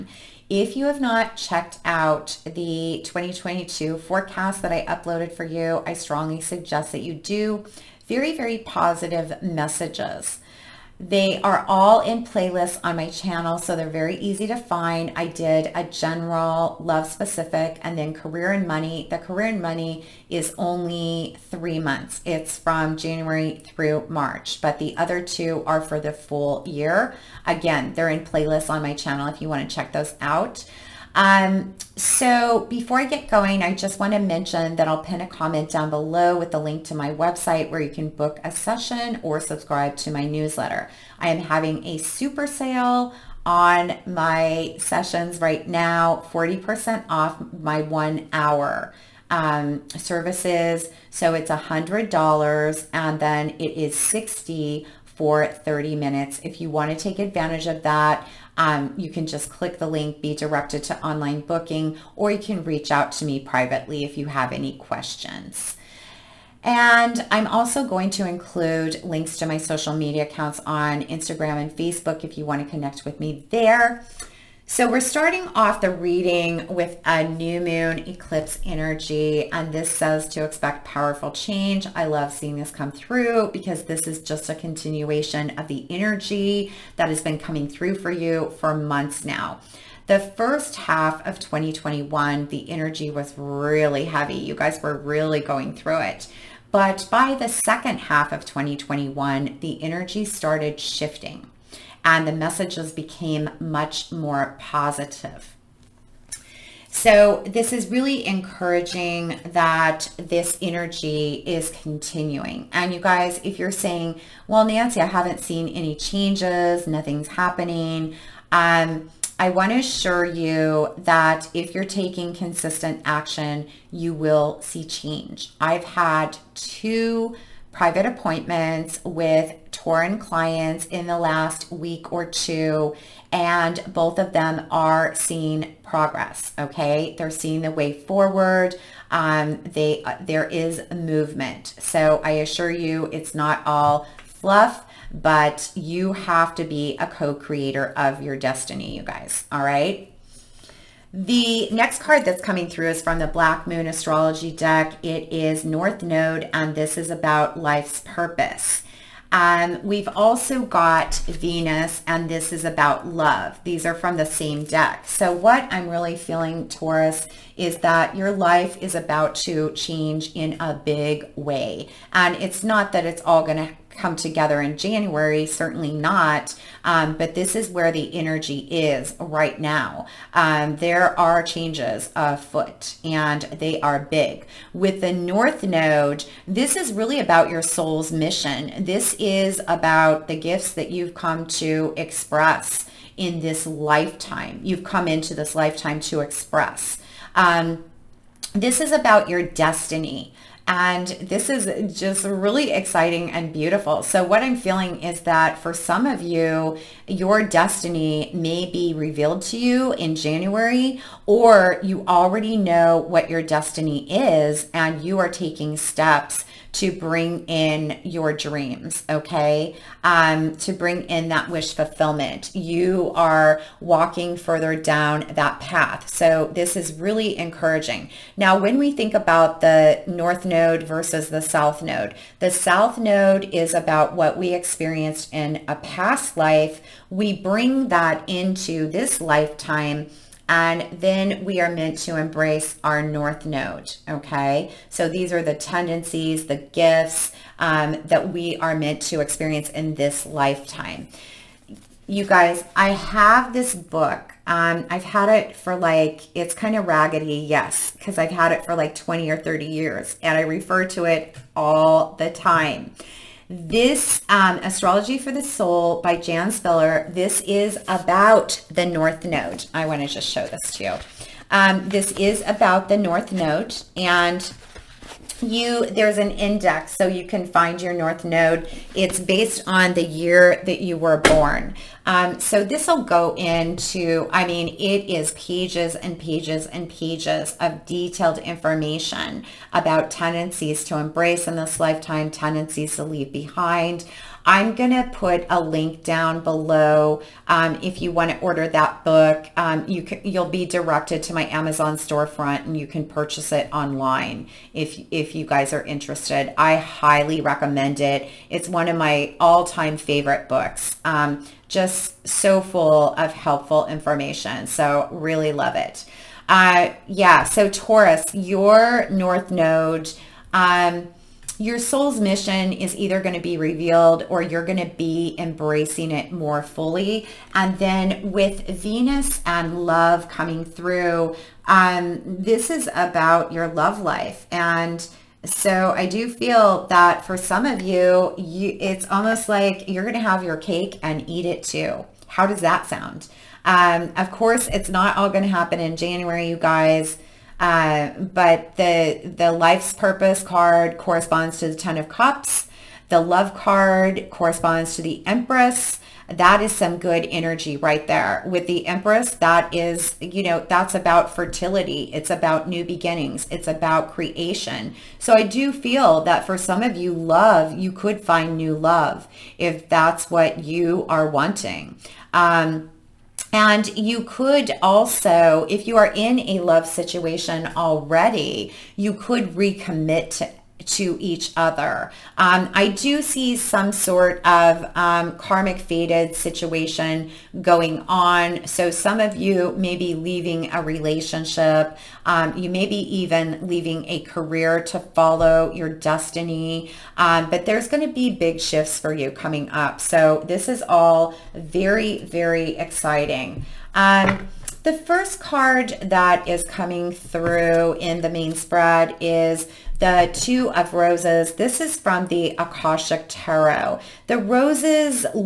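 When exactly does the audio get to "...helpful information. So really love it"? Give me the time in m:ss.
5:13.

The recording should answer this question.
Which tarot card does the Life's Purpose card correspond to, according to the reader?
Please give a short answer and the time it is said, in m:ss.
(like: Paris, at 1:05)
Ten of Cups, at 5:51.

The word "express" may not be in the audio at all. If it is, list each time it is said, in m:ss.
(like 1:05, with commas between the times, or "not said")
3:11, 3:16.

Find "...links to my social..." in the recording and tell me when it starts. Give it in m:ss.
1:09.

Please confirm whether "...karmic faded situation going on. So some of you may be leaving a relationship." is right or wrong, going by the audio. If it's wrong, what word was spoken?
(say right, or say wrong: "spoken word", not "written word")
right.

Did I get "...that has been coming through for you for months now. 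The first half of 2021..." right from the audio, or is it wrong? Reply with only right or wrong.
right.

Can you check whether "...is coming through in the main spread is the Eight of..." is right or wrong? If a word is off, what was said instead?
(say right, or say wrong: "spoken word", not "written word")
wrong: "Two", not "Eight".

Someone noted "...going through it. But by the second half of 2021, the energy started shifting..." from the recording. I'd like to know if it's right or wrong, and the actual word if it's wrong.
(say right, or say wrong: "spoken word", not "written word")
right.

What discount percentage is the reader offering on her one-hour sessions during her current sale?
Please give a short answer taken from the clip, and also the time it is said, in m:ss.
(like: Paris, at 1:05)
40%, at 0:46.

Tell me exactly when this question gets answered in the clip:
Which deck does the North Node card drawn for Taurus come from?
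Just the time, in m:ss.
2:33.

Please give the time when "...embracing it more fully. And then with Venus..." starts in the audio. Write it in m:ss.
5:25.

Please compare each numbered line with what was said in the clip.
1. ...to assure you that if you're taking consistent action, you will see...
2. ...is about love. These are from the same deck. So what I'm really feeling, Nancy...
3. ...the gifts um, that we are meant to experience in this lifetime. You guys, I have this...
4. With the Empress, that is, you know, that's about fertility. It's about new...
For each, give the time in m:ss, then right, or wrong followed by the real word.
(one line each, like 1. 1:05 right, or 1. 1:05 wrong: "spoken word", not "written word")
1. 1:59 right
2. 2:42 wrong: "Taurus", not "Nancy"
3. 4:06 right
4. 5:58 right.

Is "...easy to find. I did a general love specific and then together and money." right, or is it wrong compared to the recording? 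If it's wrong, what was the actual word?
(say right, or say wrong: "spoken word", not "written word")
wrong: "career", not "together".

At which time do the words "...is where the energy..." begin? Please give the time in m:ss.
2:57.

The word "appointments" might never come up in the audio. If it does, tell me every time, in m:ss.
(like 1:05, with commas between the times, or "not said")
2:08.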